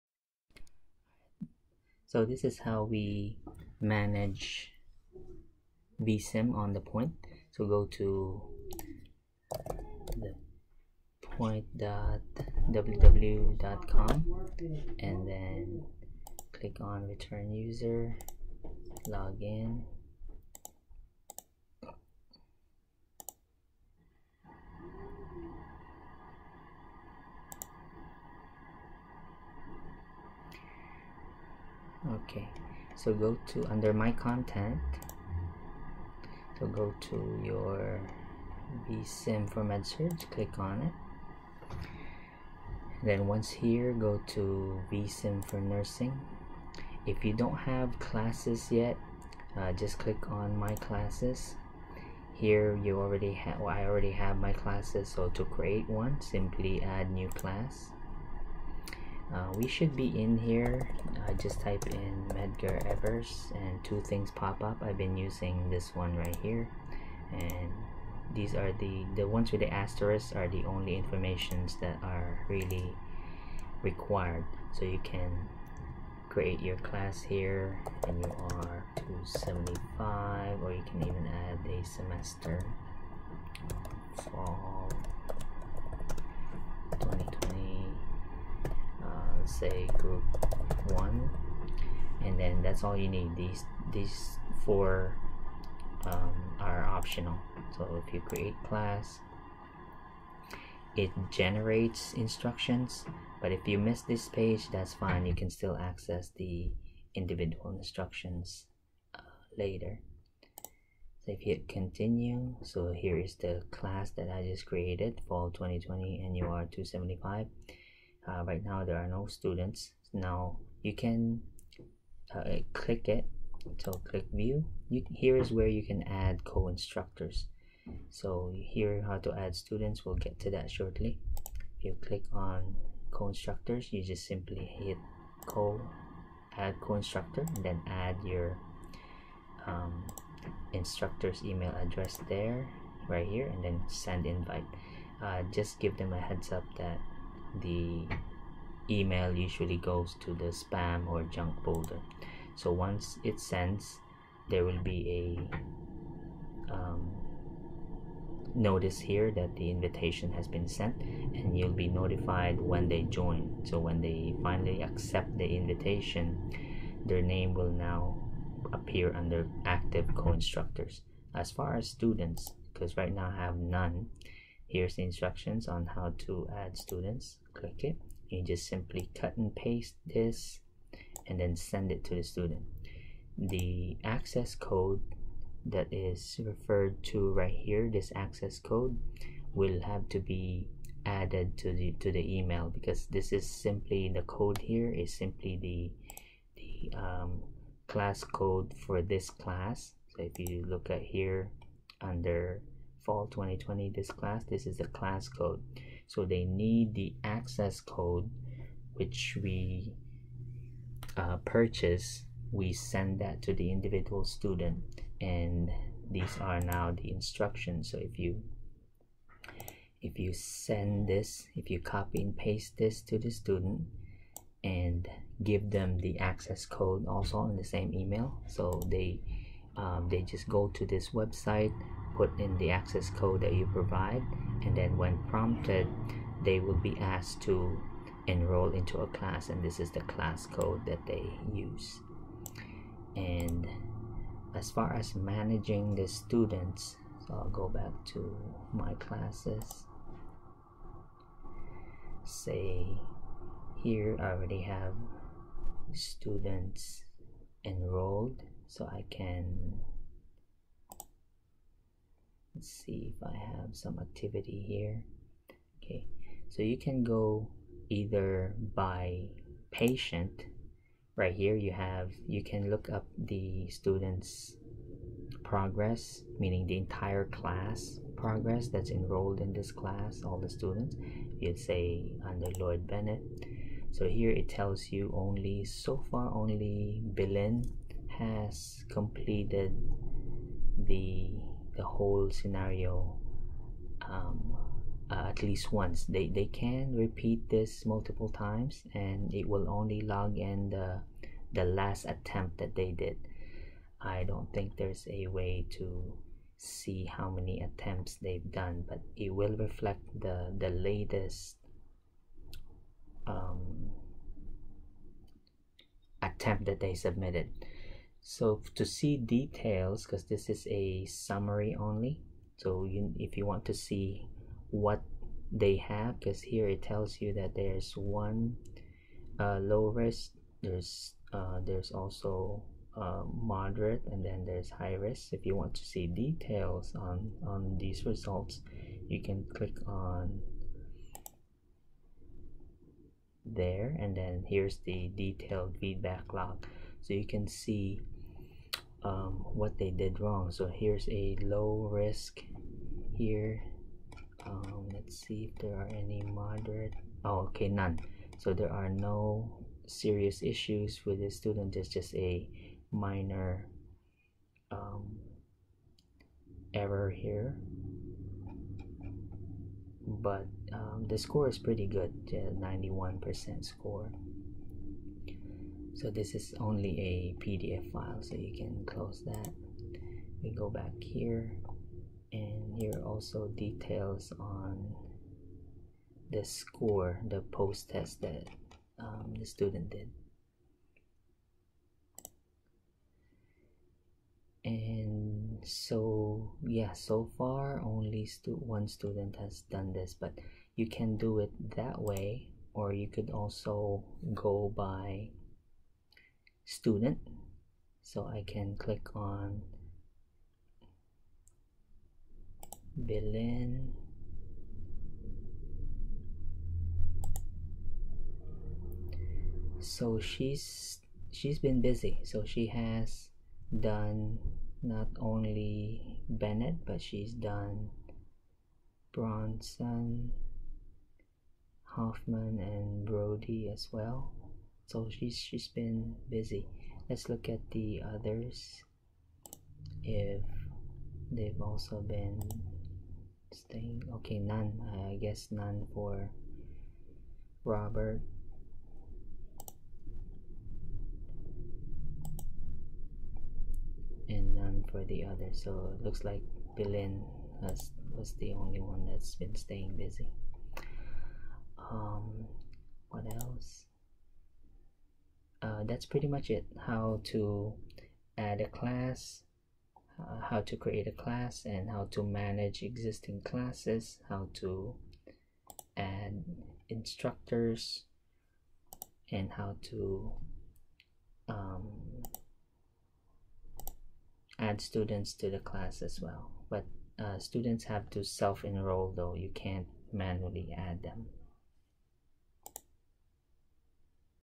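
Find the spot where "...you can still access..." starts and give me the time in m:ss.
1:45.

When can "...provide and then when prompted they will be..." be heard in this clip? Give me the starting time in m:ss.
3:53.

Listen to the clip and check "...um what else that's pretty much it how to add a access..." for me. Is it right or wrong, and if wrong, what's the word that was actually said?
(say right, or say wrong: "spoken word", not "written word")
wrong: "class", not "access".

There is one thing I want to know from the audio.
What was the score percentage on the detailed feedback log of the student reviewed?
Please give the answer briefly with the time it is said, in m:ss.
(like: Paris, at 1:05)
91%, at 6:12.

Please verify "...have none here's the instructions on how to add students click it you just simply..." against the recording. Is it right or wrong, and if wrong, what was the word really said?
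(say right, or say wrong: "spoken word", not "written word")
right.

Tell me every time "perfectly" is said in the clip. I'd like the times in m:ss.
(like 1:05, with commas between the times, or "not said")
not said.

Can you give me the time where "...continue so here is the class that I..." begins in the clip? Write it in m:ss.
1:51.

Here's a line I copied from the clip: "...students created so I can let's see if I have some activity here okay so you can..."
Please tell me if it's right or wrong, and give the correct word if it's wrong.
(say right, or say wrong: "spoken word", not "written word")
wrong: "enrolled", not "created".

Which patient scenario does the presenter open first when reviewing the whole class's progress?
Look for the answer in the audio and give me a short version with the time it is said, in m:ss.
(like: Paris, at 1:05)
Lloyd Bennett, at 4:42.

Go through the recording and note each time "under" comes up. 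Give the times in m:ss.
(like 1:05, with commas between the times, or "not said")
0:33, 2:49, 3:22, 4:42.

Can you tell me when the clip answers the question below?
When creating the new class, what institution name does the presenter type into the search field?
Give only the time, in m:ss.
1:02.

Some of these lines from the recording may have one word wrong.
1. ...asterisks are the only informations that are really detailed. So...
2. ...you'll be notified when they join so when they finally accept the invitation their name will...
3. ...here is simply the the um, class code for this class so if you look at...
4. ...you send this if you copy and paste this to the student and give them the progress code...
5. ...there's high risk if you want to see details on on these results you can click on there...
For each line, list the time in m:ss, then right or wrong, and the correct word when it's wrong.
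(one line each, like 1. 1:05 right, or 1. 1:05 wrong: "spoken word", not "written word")
1. 1:09 wrong: "required", not "detailed"
2. 2:41 right
3. 3:14 right
4. 3:40 wrong: "access", not "progress"
5. 5:34 right.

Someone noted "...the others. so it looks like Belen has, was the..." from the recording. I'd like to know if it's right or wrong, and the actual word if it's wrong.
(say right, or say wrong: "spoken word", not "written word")
right.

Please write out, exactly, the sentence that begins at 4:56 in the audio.
They, they can repeat this multiple times and it will only log in the, the last attempt that they did.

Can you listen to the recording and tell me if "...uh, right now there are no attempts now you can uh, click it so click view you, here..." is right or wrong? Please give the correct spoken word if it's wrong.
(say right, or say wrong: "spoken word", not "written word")
wrong: "students", not "attempts".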